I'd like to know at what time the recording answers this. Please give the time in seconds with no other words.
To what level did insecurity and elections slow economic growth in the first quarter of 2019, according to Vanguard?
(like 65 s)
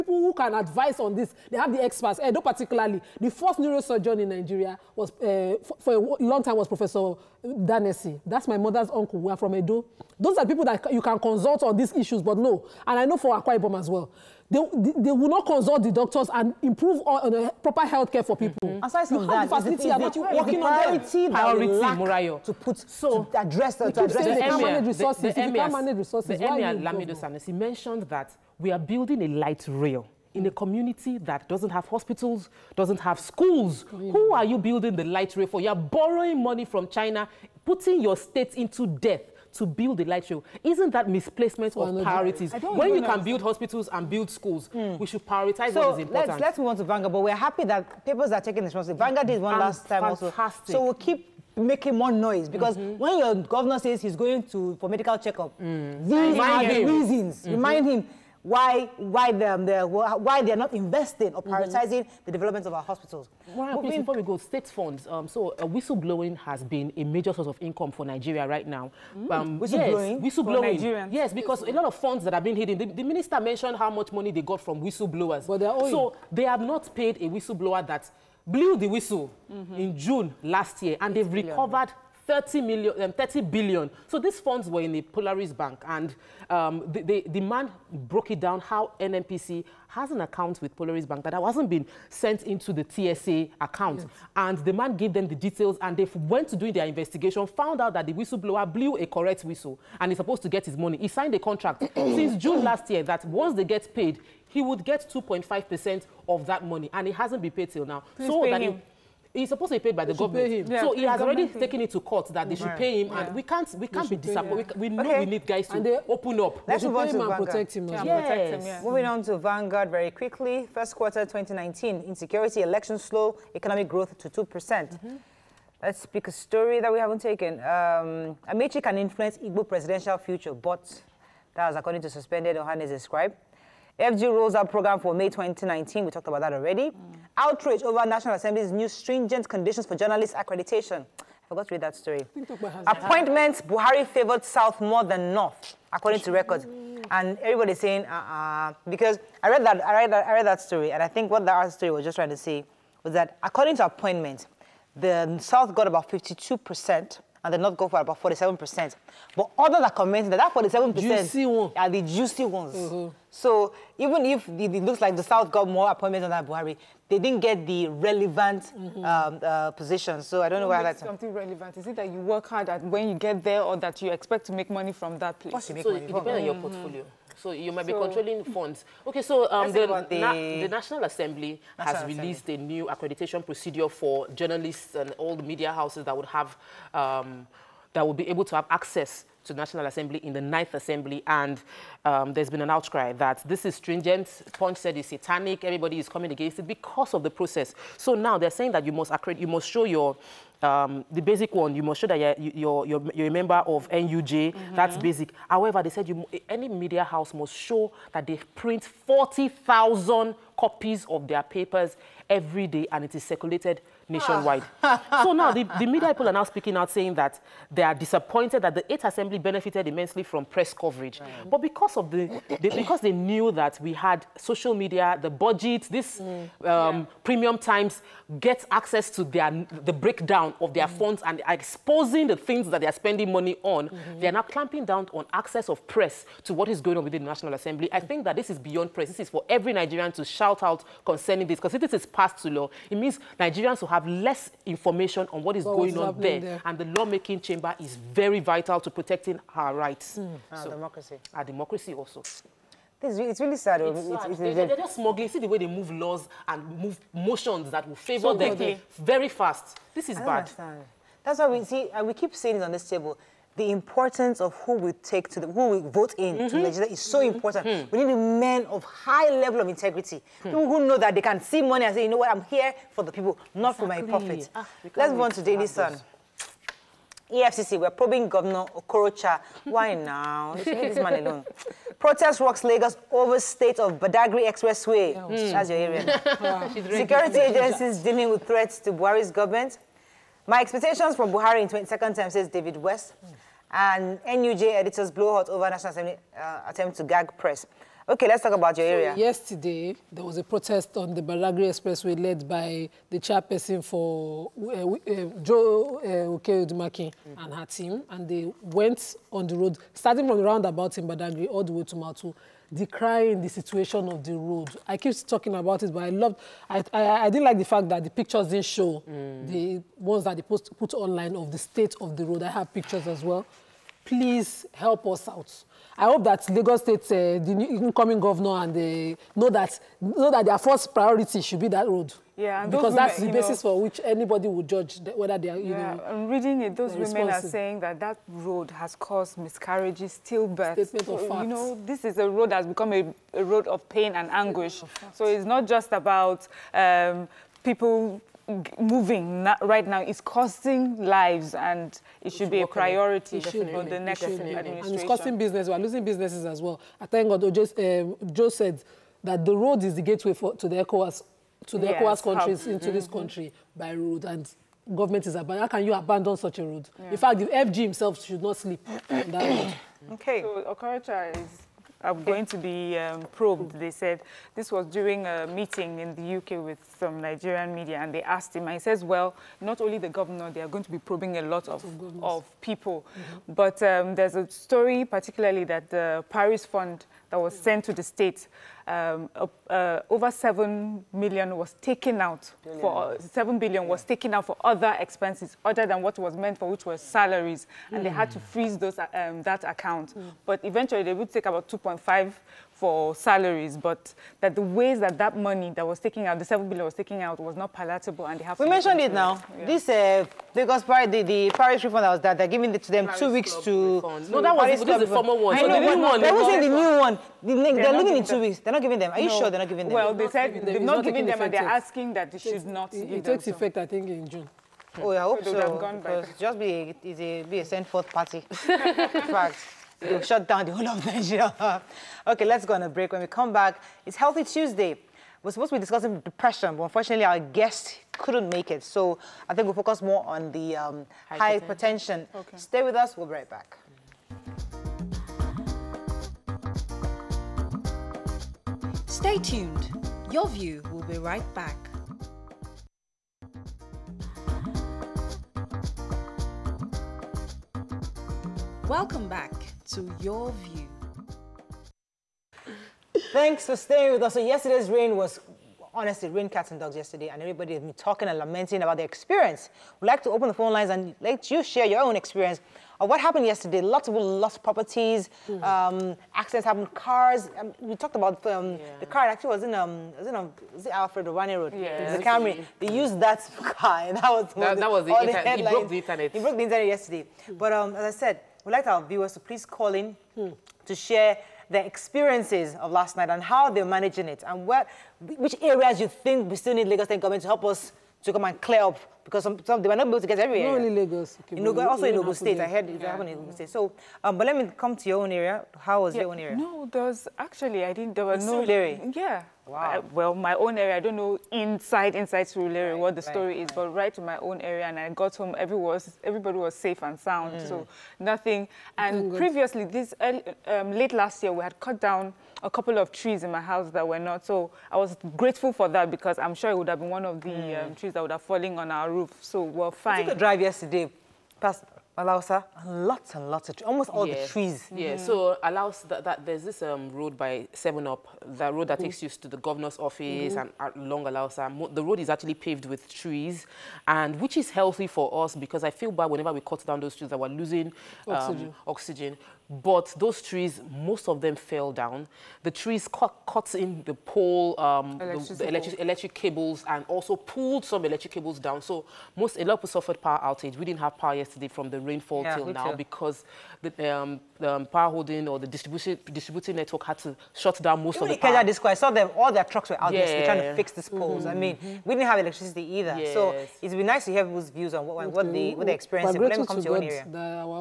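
124 s.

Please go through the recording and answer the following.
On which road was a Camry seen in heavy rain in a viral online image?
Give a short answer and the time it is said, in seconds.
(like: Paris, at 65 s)
Alfred Rewane Road, at 480 s.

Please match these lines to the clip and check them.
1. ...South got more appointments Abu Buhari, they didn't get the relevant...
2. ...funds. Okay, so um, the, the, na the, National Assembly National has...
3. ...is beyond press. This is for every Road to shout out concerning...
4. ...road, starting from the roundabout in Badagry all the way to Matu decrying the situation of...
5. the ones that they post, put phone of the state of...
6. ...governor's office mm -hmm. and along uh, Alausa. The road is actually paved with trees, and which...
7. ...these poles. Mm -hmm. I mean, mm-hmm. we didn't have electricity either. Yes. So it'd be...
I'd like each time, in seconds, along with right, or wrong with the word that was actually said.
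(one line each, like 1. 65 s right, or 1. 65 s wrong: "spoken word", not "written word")
1. 165 s right
2. 178 s right
3. 238 s wrong: "Nigerian", not "Road"
4. 309 s right
5. 319 s wrong: "online", not "phone"
6. 539 s right
7. 570 s right.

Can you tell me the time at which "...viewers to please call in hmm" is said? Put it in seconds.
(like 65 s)
489 s.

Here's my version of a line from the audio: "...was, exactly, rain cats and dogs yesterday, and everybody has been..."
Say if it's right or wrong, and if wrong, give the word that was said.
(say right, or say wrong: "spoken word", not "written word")
wrong: "honestly", not "exactly".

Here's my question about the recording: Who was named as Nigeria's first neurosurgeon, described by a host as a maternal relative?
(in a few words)
Professor Danesi.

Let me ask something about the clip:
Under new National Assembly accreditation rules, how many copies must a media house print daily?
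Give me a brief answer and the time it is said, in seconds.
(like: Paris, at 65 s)
40,000, at 209 s.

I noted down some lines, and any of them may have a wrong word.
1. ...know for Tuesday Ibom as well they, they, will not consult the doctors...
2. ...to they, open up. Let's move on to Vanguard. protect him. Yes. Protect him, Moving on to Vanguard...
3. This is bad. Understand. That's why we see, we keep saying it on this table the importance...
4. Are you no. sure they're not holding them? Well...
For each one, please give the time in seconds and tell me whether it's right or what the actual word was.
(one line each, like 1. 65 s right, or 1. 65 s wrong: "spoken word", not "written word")
1. 13 s wrong: "Akwa", not "Tuesday"
2. 115 s right
3. 259 s right
4. 419 s wrong: "giving", not "holding".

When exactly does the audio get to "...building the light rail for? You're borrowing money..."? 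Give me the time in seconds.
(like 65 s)
34 s.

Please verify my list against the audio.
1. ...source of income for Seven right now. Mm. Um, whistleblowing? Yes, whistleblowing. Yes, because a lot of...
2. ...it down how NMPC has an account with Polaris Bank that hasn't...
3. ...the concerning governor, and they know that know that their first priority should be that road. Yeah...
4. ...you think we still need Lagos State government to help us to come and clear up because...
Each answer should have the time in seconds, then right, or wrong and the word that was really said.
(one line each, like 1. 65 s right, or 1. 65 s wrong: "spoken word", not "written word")
1. 67 s wrong: "Nigeria", not "Seven"
2. 88 s right
3. 327 s wrong: "incoming", not "concerning"
4. 496 s right.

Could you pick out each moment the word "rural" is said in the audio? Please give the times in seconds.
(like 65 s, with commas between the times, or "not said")
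512 s.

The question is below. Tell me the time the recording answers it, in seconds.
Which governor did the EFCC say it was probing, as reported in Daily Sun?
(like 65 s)
278 s.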